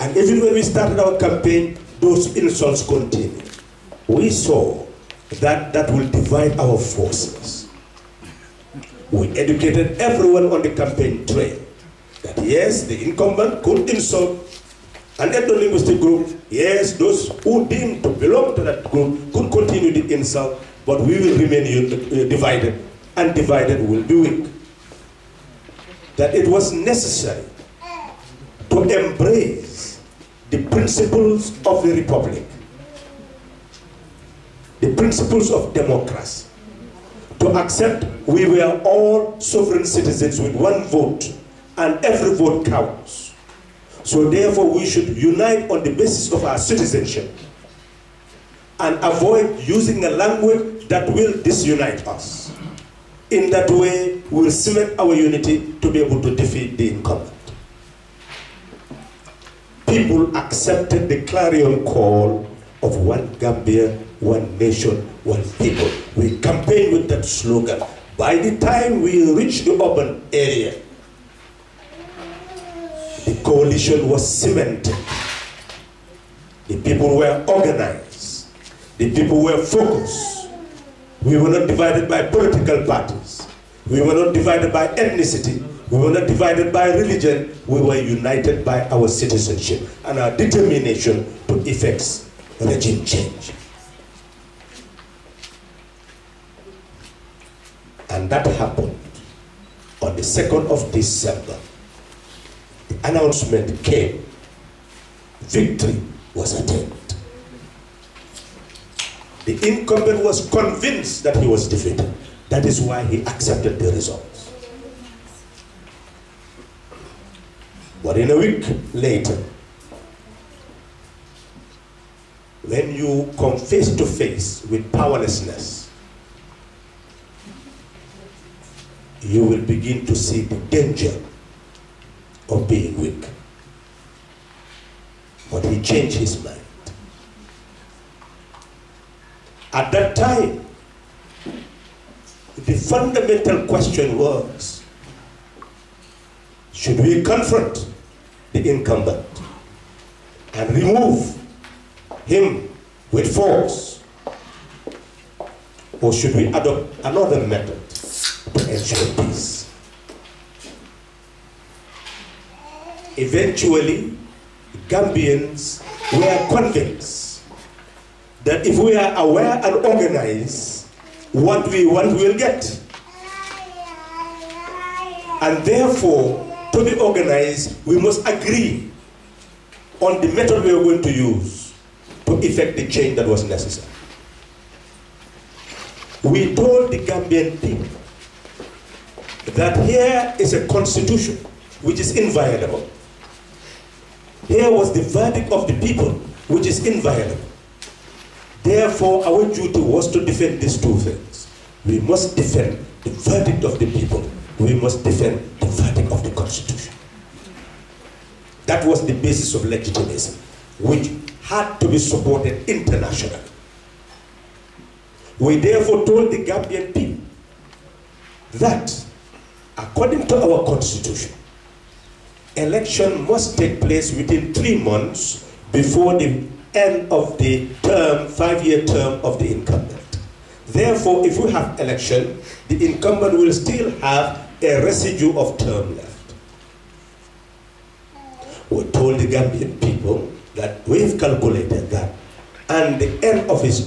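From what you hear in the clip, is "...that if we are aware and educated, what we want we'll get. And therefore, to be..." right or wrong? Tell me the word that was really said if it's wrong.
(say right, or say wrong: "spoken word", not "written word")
wrong: "organized", not "educated".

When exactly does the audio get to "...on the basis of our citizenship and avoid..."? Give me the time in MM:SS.
00:45.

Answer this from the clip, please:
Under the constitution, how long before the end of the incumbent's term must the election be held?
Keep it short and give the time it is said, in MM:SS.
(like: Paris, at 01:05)
3 months, at 03:44.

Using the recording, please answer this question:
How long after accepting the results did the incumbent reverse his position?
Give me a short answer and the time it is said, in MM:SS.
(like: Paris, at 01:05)
A week, at 01:58.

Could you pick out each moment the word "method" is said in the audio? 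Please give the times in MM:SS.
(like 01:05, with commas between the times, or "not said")
02:37, 03:00.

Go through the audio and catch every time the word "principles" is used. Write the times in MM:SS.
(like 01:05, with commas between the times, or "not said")
00:30, 00:34.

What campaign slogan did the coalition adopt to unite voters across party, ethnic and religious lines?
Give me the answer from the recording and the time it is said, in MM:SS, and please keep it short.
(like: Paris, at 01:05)
One Gambia one nation, one people, at 01:02.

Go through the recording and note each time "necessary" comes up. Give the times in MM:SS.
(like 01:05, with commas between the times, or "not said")
00:26, 03:03.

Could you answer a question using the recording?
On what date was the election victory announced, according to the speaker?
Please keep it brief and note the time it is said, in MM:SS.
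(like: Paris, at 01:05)
2nd of December, at 01:40.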